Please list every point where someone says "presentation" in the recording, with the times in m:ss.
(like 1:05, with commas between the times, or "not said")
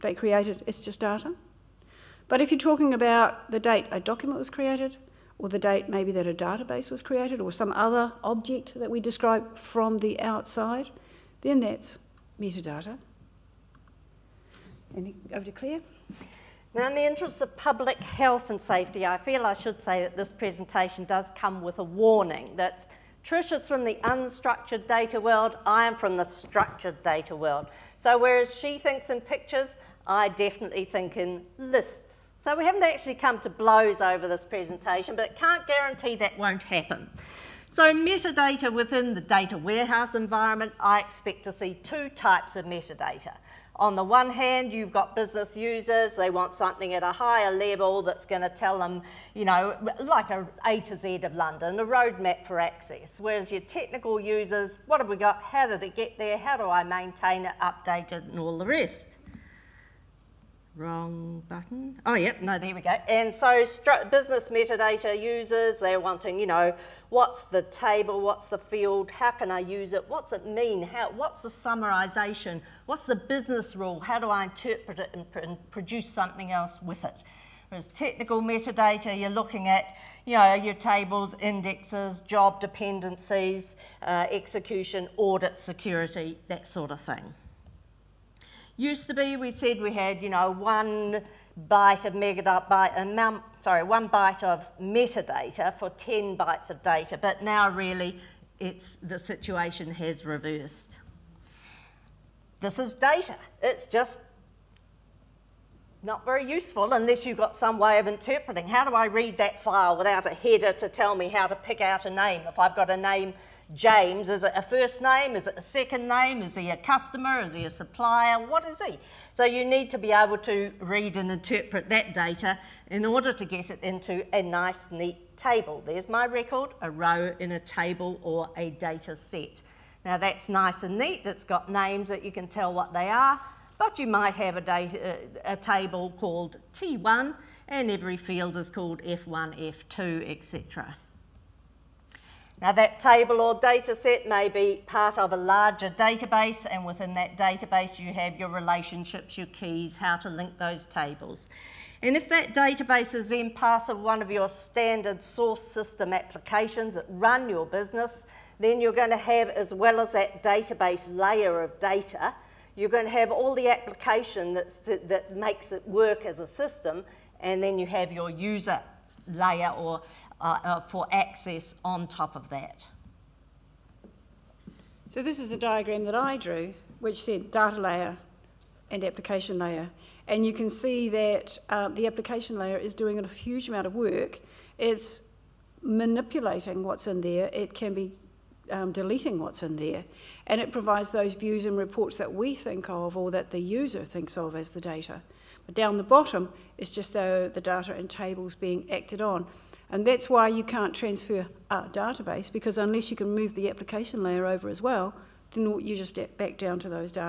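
0:20, 0:34.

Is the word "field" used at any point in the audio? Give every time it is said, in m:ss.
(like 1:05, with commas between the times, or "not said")
1:08, 2:18.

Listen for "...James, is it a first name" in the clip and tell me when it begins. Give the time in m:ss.
1:53.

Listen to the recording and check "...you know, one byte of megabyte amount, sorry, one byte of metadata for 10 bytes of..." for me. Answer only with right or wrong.
right.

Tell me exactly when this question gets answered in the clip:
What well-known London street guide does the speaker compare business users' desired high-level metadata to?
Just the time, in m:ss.
0:50.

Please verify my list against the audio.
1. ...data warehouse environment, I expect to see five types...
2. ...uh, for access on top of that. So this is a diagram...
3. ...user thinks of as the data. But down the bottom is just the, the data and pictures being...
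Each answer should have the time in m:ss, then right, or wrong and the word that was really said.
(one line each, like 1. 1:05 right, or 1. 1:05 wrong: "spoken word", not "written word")
1. 0:39 wrong: "two", not "five"
2. 2:50 right
3. 3:13 wrong: "tables", not "pictures".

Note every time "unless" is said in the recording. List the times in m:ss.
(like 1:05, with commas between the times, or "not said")
1:46, 3:22.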